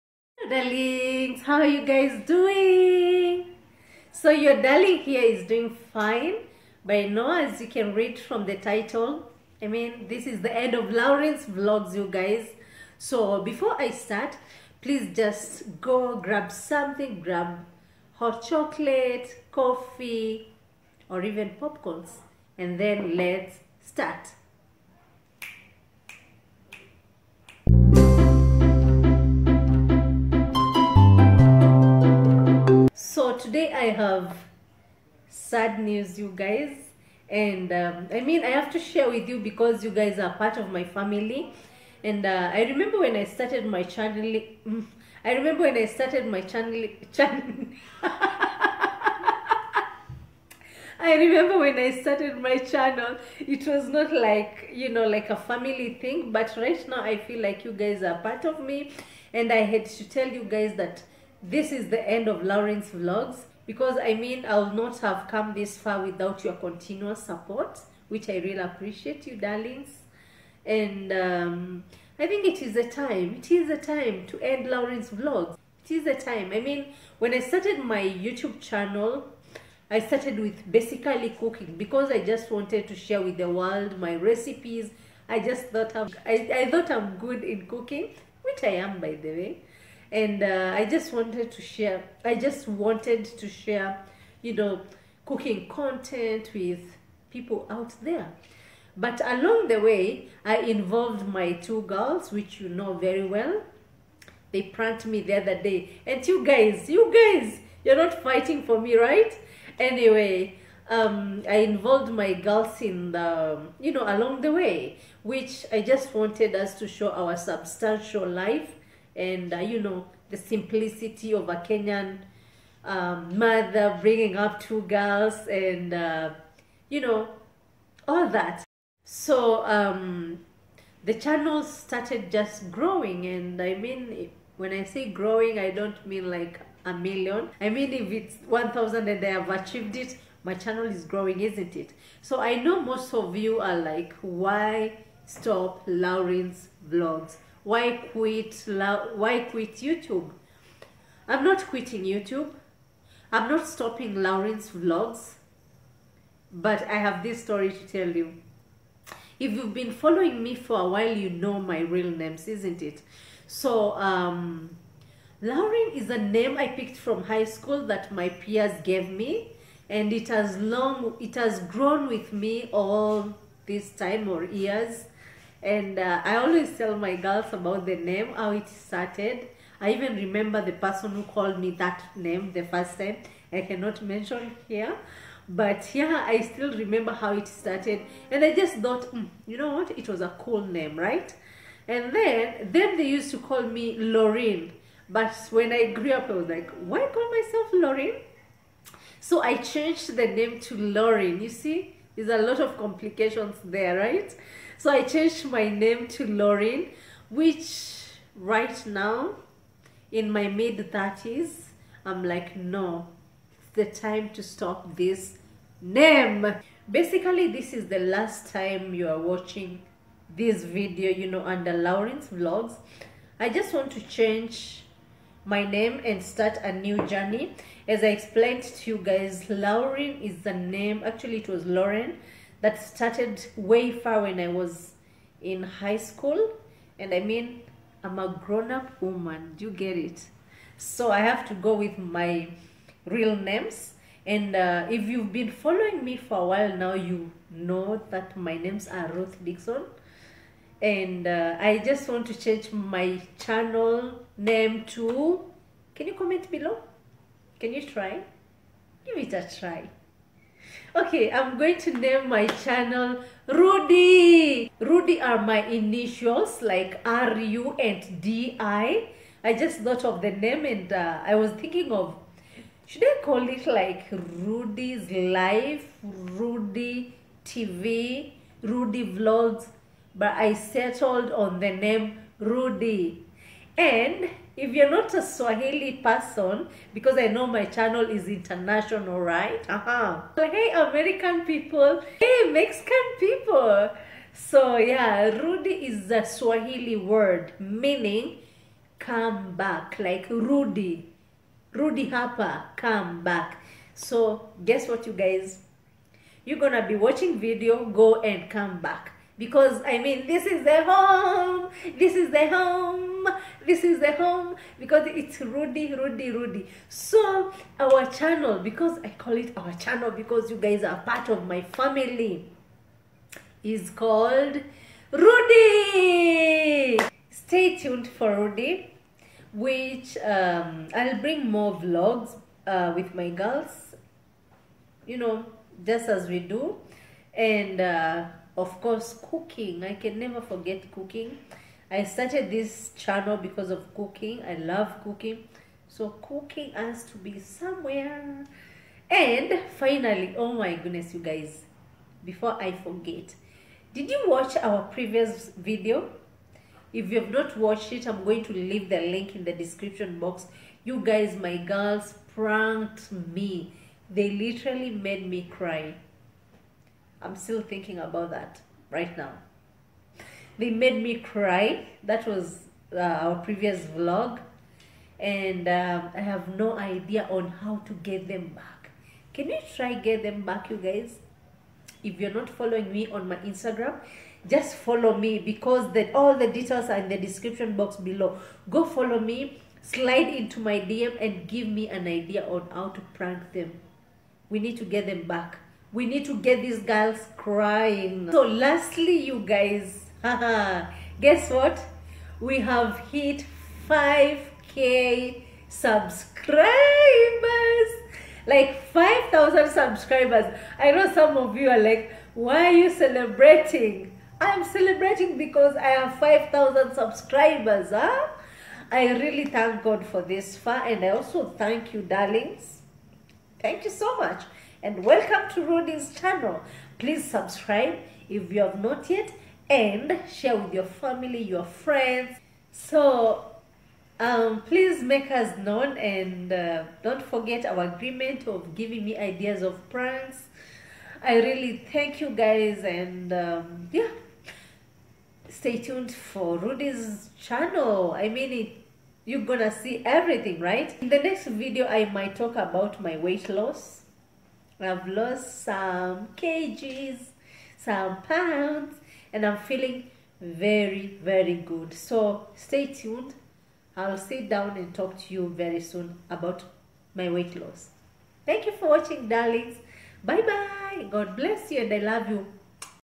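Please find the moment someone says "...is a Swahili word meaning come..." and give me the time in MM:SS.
04:55.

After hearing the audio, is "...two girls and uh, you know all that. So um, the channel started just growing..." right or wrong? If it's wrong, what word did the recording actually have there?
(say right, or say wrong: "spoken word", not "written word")
right.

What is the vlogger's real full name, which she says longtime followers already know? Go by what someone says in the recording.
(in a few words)
Ruth Dickson.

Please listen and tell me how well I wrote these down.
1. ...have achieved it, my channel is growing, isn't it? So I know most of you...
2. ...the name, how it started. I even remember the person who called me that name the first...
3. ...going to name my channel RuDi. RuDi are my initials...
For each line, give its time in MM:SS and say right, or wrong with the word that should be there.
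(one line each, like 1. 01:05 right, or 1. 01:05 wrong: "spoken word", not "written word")
1. 02:19 right
2. 02:57 right
3. 04:21 right.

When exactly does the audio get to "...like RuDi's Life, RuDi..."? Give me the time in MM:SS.
04:33.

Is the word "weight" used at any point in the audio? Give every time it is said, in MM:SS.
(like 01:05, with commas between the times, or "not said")
07:33, 07:47.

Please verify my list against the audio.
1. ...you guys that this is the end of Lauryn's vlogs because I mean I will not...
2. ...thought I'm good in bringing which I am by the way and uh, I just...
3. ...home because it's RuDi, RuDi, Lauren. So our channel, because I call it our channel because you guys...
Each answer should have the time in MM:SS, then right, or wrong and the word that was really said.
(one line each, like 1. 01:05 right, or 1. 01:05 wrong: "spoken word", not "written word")
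1. 01:00 right
2. 01:26 wrong: "cooking", not "bringing"
3. 05:14 wrong: "RuDi", not "Lauren".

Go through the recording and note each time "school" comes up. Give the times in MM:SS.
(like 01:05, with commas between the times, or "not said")
02:47, 03:55.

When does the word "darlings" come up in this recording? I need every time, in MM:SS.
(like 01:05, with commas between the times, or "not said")
00:00, 00:04, 01:09, 07:02, 07:49.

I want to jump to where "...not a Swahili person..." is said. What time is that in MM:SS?
04:44.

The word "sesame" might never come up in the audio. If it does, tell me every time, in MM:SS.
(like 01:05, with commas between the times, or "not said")
not said.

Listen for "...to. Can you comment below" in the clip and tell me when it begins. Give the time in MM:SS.
04:14.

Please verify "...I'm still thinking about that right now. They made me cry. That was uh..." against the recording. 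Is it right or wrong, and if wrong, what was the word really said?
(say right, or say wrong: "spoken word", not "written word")
right.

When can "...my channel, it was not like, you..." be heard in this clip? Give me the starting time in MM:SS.
00:52.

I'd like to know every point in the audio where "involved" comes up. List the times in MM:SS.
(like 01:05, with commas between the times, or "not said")
01:40, 01:51.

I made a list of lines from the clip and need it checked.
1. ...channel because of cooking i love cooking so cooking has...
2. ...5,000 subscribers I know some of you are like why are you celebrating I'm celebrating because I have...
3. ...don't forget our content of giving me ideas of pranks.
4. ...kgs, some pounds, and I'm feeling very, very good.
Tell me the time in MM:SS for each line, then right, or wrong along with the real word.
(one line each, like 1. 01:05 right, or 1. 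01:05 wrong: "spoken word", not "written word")
1. 05:42 right
2. 06:48 right
3. 07:17 wrong: "agreement", not "content"
4. 07:36 right.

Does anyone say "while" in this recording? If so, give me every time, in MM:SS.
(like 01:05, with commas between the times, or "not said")
02:40, 04:06.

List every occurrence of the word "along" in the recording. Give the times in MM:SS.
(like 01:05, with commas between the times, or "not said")
01:39, 01:54.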